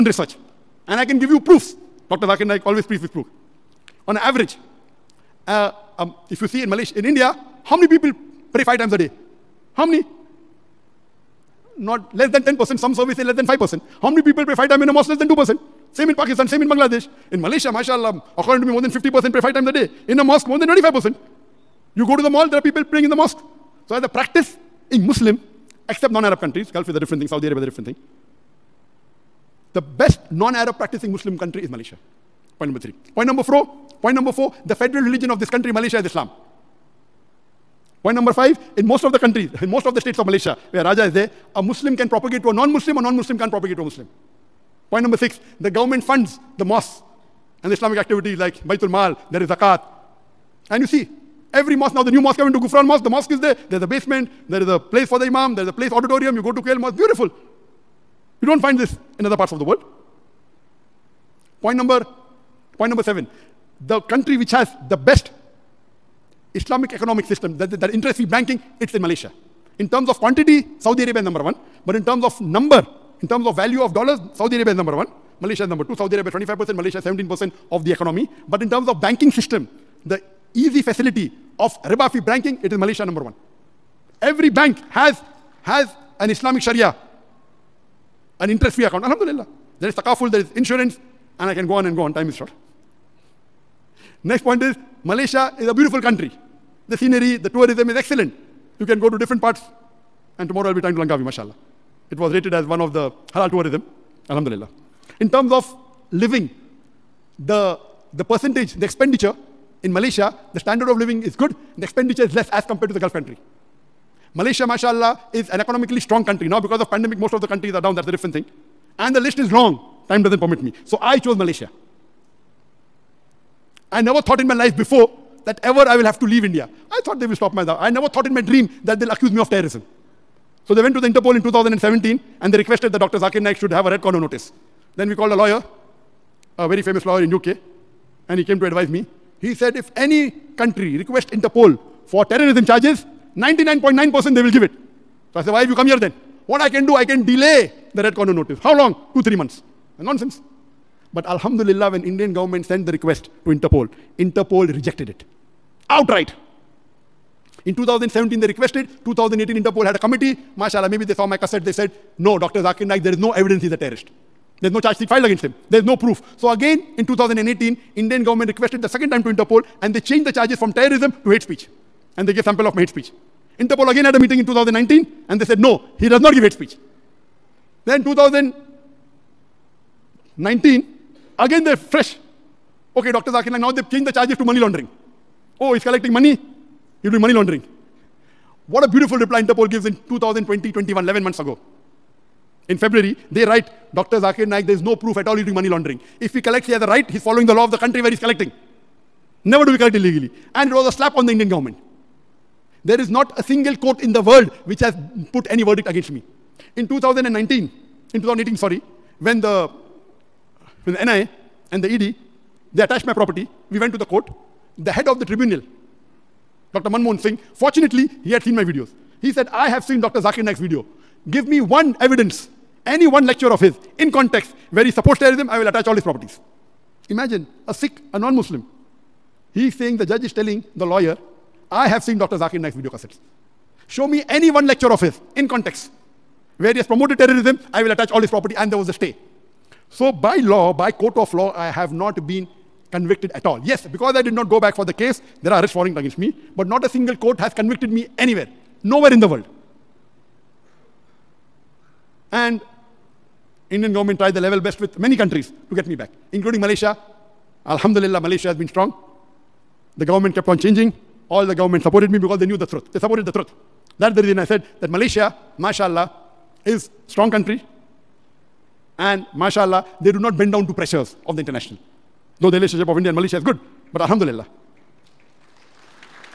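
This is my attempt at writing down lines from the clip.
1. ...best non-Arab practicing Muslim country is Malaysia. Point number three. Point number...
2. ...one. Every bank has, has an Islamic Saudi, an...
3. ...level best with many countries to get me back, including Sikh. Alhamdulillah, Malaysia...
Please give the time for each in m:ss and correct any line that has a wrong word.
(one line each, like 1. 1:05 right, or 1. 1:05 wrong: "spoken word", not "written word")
1. 0:29 right
2. 1:23 wrong: "Sharia", not "Saudi"
3. 4:14 wrong: "Malaysia", not "Sikh".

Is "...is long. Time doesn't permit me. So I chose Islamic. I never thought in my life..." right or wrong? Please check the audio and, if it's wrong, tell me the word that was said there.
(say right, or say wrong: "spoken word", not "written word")
wrong: "Malaysia", not "Islamic".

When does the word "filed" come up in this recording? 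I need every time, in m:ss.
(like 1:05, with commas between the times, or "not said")
2:45.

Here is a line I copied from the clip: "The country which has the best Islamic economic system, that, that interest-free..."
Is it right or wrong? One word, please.
right.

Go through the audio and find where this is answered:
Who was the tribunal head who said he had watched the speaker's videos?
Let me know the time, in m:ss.
3:36.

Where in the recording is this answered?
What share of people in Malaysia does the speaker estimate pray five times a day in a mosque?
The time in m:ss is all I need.
0:20.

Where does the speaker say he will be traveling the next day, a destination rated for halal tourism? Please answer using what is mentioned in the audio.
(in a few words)
Langkawi.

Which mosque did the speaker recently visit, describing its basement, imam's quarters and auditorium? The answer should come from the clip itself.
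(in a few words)
Gufran Mosque.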